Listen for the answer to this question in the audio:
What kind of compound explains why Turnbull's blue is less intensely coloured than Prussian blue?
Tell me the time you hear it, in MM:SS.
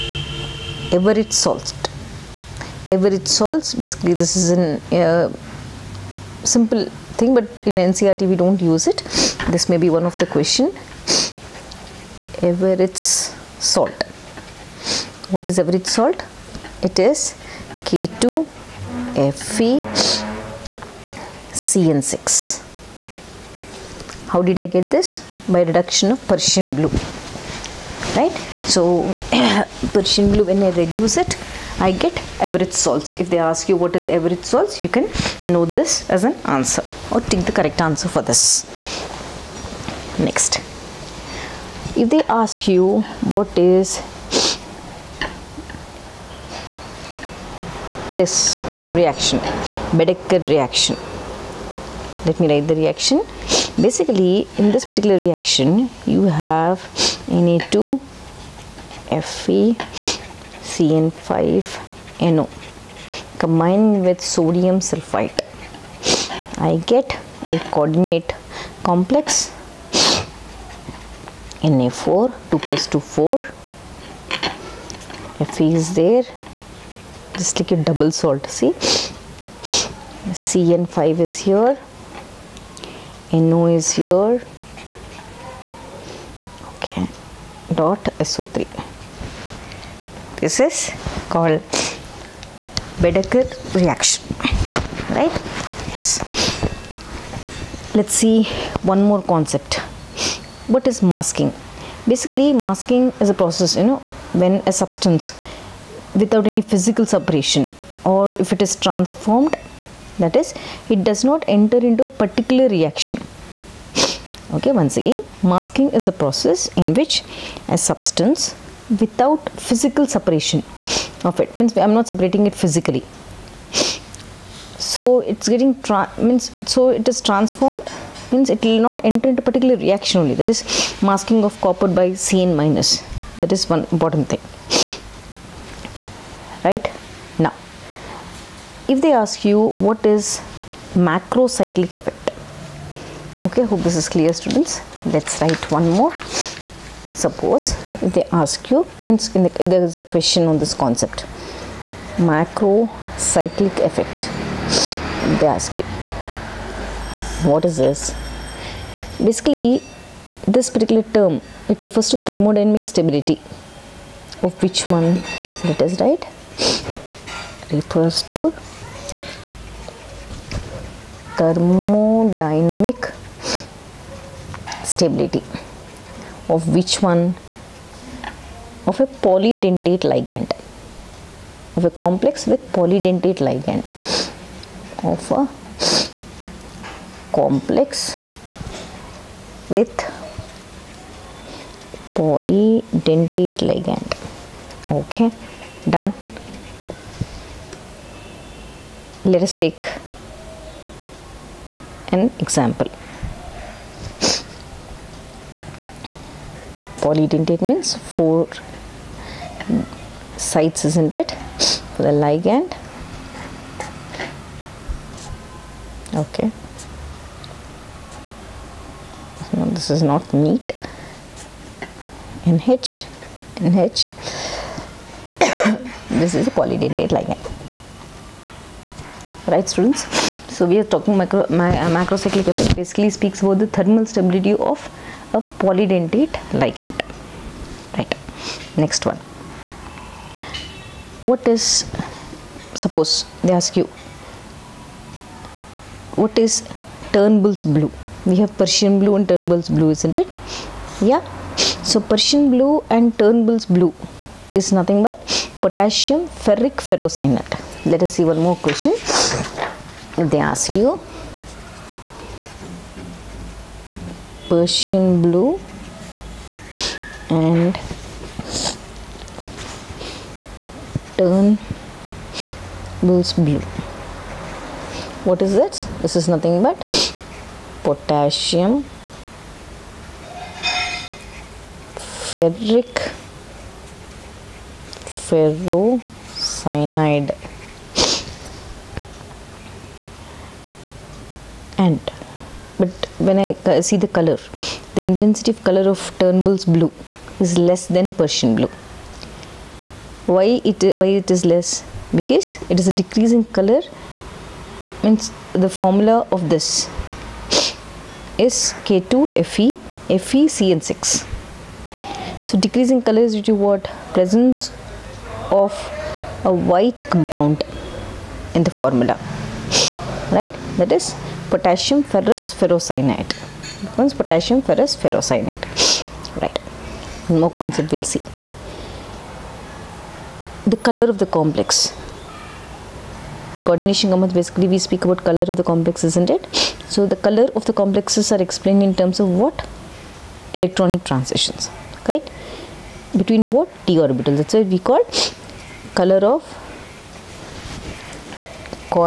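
05:16.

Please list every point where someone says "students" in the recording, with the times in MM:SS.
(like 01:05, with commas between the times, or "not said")
02:24, 03:49.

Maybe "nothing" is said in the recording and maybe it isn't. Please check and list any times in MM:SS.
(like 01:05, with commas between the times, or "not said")
04:14, 04:36.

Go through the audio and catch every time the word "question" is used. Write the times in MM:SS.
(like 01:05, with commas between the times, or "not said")
00:10, 02:30, 04:18.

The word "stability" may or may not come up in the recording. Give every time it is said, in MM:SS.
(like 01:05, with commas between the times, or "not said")
02:42, 02:54, 03:54.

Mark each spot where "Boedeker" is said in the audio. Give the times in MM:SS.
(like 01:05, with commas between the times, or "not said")
00:49, 01:33.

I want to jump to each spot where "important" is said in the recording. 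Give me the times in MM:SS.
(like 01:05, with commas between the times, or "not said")
02:13.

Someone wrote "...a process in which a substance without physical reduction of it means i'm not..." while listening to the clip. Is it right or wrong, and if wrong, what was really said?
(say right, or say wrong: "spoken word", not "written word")
wrong: "separation", not "reduction".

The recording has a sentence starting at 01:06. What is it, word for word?
I get a coordinate complex Na4, 2 plus 2, 4.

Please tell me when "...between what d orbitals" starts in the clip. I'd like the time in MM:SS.
05:43.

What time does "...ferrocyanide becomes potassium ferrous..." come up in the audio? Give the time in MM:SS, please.
05:22.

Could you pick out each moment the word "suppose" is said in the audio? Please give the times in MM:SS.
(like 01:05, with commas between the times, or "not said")
02:27, 04:02.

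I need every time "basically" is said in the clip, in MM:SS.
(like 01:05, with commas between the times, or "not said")
00:03, 00:53, 01:42, 02:39, 03:52, 05:34.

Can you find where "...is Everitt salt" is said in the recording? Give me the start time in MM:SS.
00:15.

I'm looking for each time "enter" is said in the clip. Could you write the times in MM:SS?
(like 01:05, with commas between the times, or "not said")
01:51, 02:09.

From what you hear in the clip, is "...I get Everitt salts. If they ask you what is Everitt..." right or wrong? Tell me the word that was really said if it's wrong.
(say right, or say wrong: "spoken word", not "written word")
right.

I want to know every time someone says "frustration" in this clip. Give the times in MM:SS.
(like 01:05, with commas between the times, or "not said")
not said.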